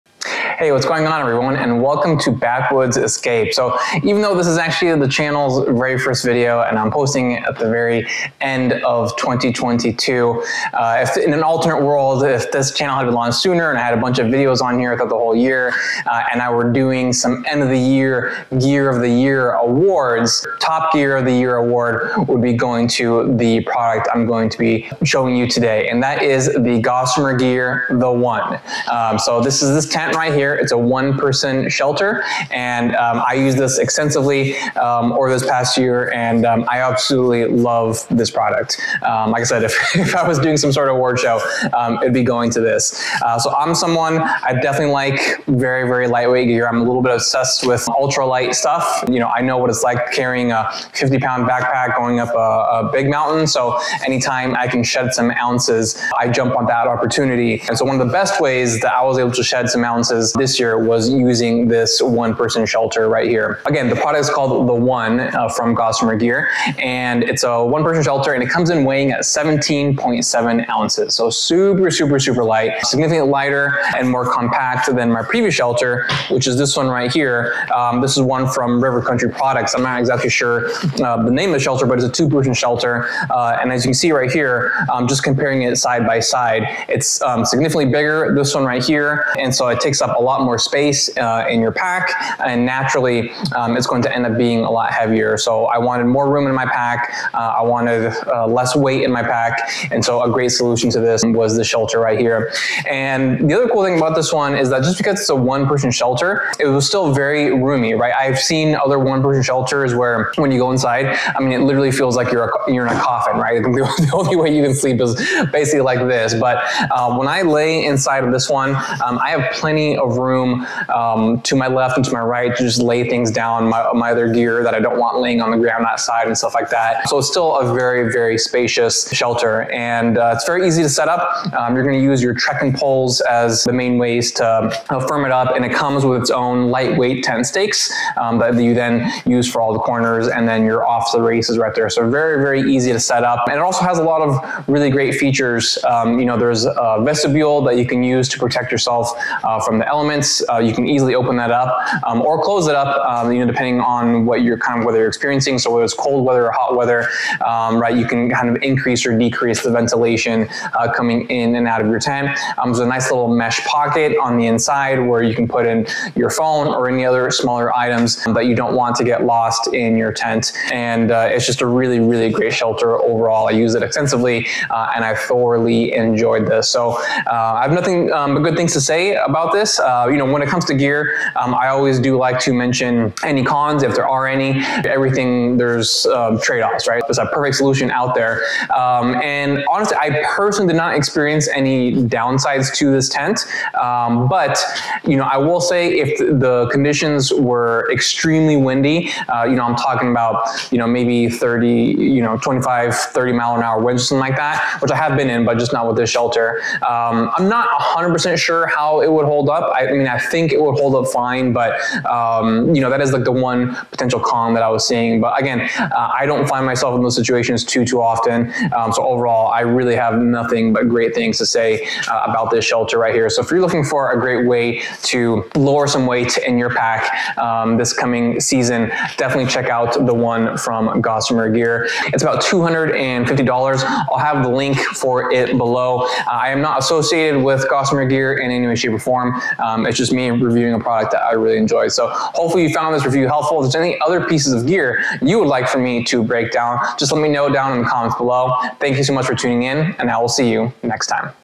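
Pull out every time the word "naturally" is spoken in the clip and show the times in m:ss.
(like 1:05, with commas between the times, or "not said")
1:32.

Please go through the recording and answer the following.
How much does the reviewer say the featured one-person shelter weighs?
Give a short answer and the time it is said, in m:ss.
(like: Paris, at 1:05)
17.7 ounces, at 1:09.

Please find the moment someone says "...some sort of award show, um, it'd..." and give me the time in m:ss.
0:40.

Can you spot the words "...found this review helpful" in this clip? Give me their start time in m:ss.
4:02.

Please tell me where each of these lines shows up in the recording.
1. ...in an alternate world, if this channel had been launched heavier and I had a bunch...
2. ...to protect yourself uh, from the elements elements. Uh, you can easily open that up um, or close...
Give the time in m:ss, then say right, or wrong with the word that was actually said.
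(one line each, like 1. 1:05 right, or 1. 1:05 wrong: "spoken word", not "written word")
1. 0:11 wrong: "sooner", not "heavier"
2. 2:28 right.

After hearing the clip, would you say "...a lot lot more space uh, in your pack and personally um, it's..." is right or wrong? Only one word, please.
wrong.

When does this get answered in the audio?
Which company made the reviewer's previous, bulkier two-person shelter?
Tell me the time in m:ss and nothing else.
1:18.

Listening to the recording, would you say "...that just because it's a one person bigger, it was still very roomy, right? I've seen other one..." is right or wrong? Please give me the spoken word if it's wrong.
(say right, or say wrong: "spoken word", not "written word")
wrong: "shelter", not "bigger".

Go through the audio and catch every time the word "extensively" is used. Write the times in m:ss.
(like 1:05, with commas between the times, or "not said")
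0:33, 2:53.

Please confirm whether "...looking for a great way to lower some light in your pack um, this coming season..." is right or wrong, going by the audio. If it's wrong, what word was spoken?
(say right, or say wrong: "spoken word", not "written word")
wrong: "weight", not "light".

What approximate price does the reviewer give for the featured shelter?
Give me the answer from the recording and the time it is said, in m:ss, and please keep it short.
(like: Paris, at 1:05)
$250, at 3:52.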